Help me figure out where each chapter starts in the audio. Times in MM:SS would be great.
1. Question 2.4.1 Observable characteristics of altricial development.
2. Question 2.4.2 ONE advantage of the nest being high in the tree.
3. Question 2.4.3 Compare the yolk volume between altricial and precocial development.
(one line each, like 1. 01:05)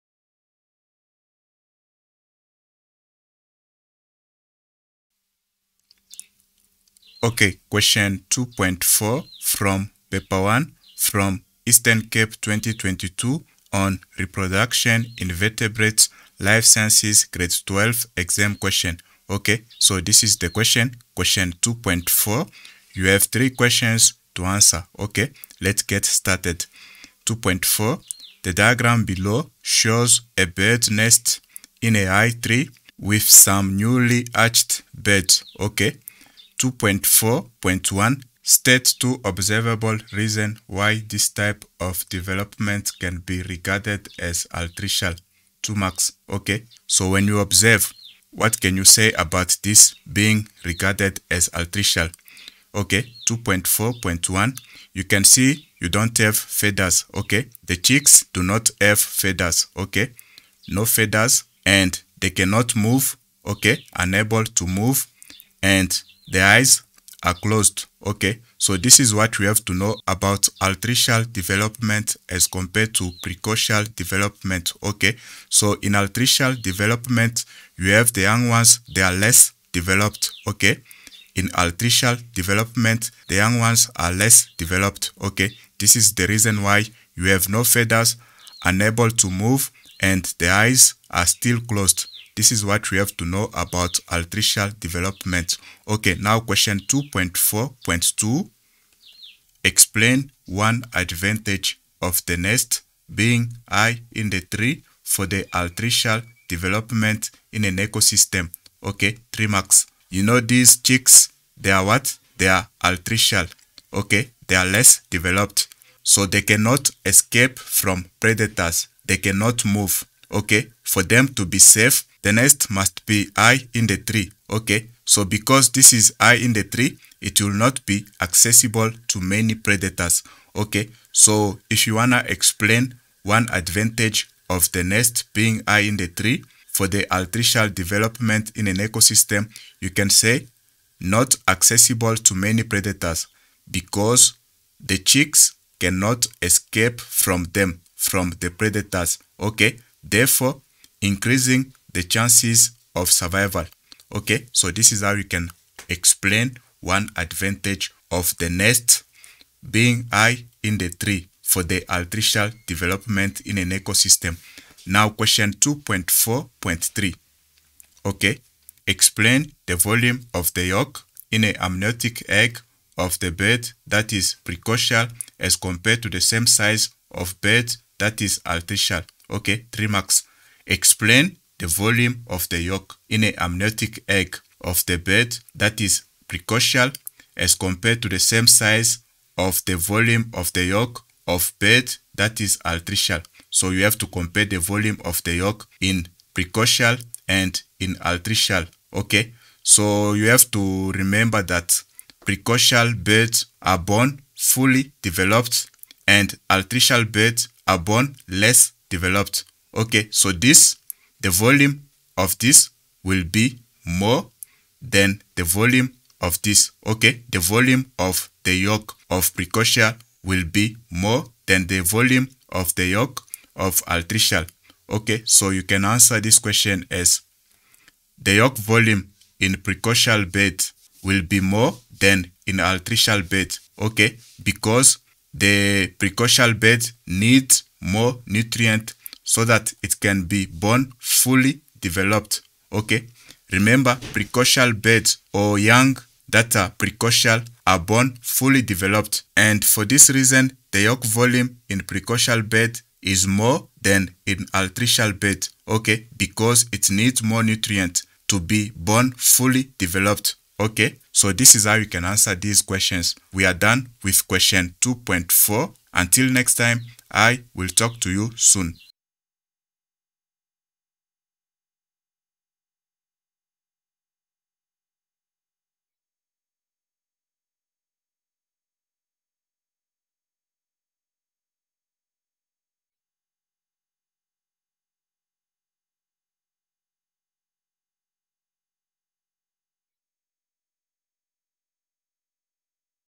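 1. 00:27
2. 01:36
3. 02:45.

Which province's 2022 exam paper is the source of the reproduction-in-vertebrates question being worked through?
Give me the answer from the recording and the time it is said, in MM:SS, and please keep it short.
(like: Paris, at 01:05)
Eastern Cape, at 00:11.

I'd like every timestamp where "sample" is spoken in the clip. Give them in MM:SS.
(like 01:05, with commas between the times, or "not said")
not said.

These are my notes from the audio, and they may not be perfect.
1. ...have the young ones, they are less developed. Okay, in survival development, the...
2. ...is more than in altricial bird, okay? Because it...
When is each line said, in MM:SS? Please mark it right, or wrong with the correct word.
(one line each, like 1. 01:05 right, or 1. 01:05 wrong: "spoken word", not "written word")
1. 01:17 wrong: "altricial", not "survival"
2. 04:13 right.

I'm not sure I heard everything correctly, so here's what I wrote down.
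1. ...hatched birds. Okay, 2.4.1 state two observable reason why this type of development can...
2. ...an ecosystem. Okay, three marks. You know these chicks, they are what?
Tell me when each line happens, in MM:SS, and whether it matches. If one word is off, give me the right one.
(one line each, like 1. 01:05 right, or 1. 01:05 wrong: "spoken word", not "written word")
1. 00:34 right
2. 01:47 right.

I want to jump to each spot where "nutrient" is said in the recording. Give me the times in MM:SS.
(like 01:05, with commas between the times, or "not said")
03:58, 04:17.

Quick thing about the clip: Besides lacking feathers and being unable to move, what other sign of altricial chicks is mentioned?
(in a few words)
Eyes are closed.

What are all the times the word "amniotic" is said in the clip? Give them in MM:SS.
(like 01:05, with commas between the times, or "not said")
02:51, 03:03.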